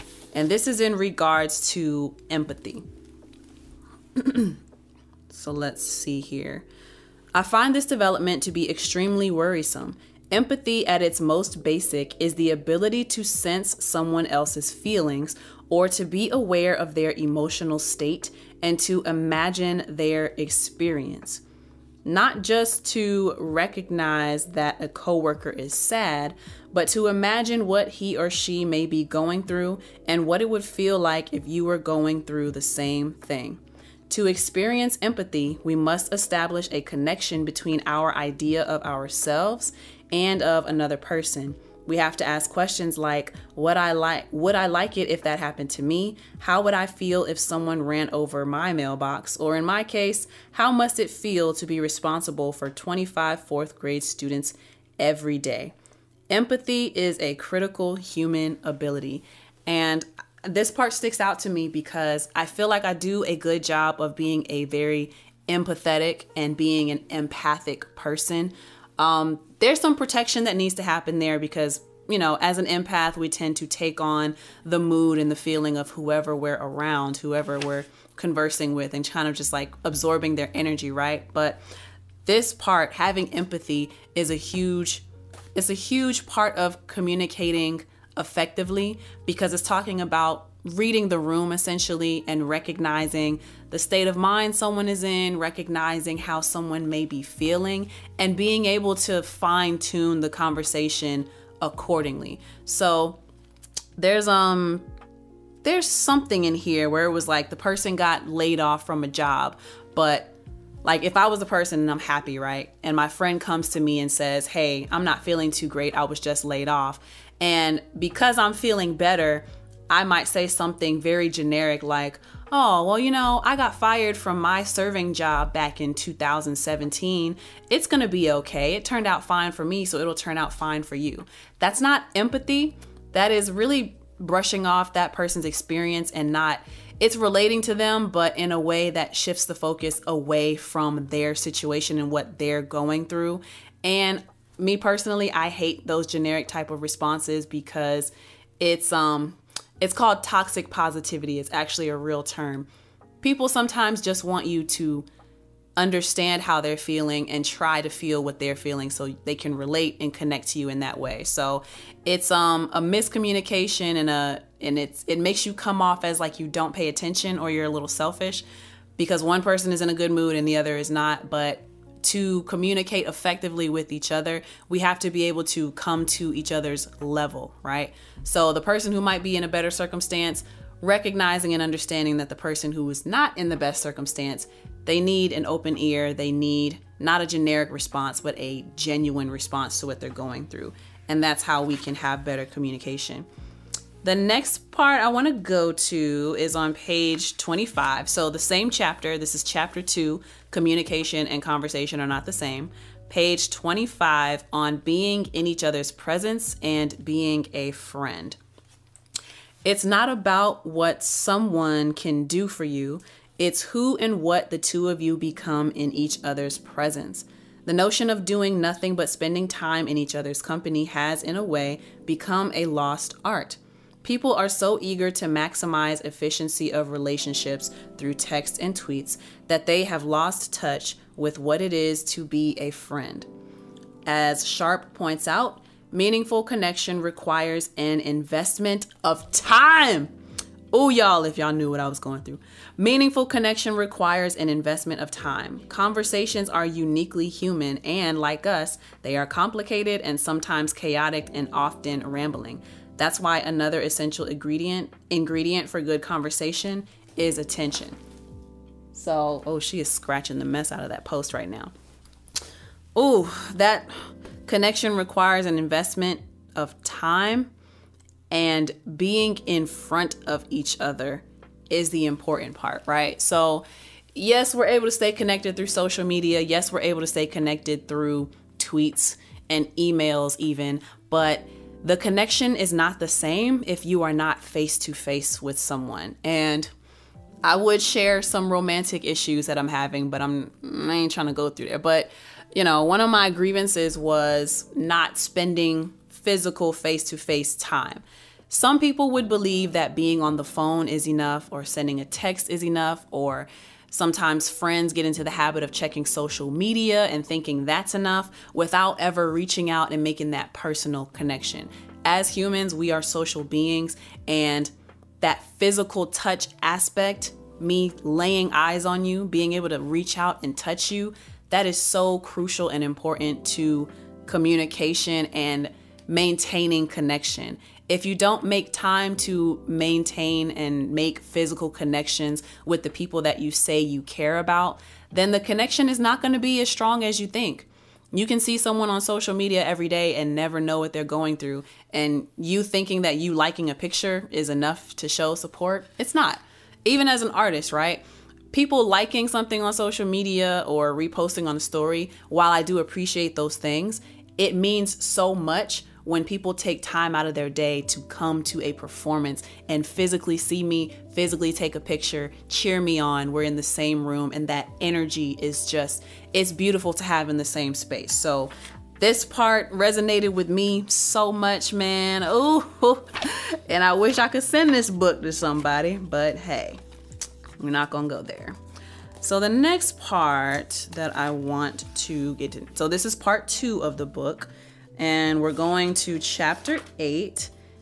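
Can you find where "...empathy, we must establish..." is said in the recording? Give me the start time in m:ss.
0:35.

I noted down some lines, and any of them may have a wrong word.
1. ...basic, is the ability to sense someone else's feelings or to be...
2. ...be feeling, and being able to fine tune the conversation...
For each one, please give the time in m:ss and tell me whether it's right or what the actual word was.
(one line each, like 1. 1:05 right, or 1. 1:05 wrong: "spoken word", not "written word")
1. 0:11 right
2. 1:37 right.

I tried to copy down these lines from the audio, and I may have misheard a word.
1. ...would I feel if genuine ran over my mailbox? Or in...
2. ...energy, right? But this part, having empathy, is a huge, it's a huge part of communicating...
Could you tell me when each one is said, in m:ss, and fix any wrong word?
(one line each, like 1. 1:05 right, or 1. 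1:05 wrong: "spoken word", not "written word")
1. 0:46 wrong: "someone", not "genuine"
2. 1:20 right.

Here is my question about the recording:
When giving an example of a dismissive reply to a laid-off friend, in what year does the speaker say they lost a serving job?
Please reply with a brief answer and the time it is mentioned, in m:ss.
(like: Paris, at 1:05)
2017, at 2:05.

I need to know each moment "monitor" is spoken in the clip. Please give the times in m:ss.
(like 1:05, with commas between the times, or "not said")
not said.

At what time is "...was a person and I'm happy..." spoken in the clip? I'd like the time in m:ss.
1:51.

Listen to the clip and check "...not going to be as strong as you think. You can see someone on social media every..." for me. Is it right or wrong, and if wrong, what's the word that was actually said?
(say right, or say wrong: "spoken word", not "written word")
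right.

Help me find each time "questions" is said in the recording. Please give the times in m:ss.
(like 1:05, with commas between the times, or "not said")
0:42.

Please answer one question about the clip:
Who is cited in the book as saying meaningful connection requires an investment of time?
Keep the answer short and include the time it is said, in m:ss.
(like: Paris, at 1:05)
Sharp, at 3:54.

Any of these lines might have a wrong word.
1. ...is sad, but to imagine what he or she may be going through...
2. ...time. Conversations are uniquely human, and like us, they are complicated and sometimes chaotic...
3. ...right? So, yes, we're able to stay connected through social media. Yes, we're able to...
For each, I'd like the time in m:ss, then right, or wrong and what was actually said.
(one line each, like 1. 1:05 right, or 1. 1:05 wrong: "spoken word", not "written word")
1. 0:25 right
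2. 4:05 right
3. 4:32 right.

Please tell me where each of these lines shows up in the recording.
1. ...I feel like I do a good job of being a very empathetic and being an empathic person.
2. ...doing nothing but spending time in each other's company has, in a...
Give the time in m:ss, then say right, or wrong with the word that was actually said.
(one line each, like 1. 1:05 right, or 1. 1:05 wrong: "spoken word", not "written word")
1. 1:02 right
2. 3:38 right.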